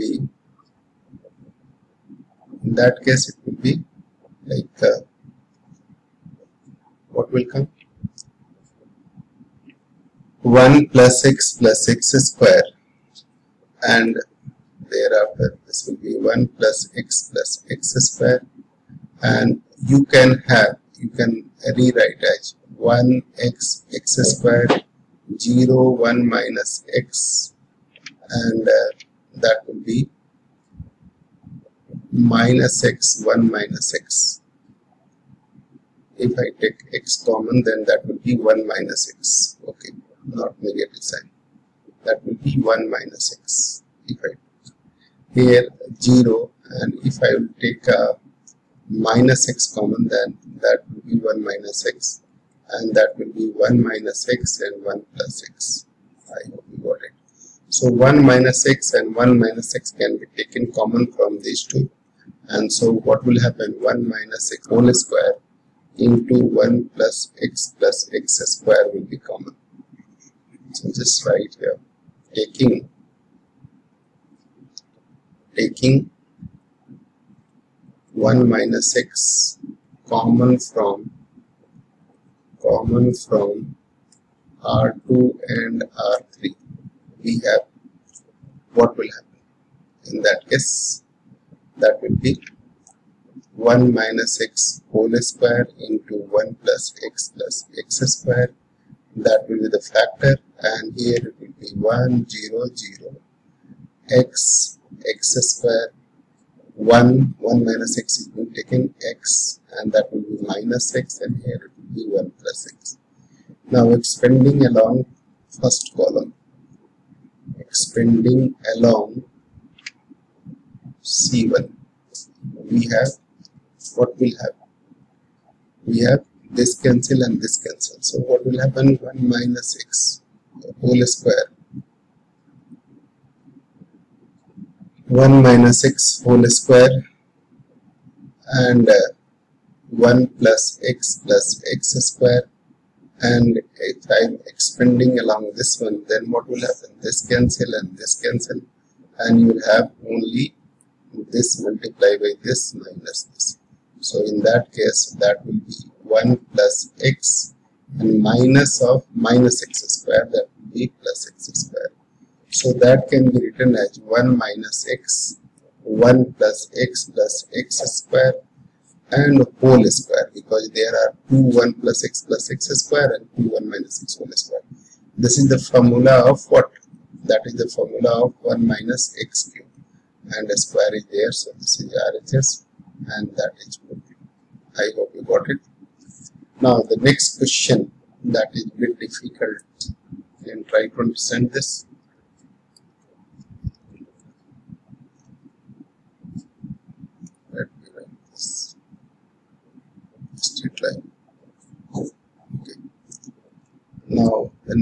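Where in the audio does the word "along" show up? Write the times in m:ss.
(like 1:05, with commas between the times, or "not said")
1:54, 1:58, 2:25.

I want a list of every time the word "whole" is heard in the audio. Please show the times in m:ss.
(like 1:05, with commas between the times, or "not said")
1:04, 1:34, 2:10, 2:16, 2:49, 2:54.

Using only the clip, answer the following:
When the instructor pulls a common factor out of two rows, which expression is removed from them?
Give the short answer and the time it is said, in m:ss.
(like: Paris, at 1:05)
1 minus x, at 1:12.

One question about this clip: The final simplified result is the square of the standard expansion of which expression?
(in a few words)
1 minus x cube.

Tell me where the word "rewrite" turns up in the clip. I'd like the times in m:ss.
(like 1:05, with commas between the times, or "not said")
0:21.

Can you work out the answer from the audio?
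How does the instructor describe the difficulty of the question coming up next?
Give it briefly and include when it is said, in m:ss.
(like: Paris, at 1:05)
a bit difficult, at 3:08.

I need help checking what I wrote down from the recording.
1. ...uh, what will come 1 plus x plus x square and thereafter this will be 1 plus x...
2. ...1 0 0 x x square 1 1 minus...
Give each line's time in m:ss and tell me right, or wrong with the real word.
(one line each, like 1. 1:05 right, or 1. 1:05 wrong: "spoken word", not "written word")
1. 0:04 right
2. 1:41 right.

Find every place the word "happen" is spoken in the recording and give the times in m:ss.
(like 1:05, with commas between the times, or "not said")
1:03, 1:29, 2:04, 2:08, 2:26.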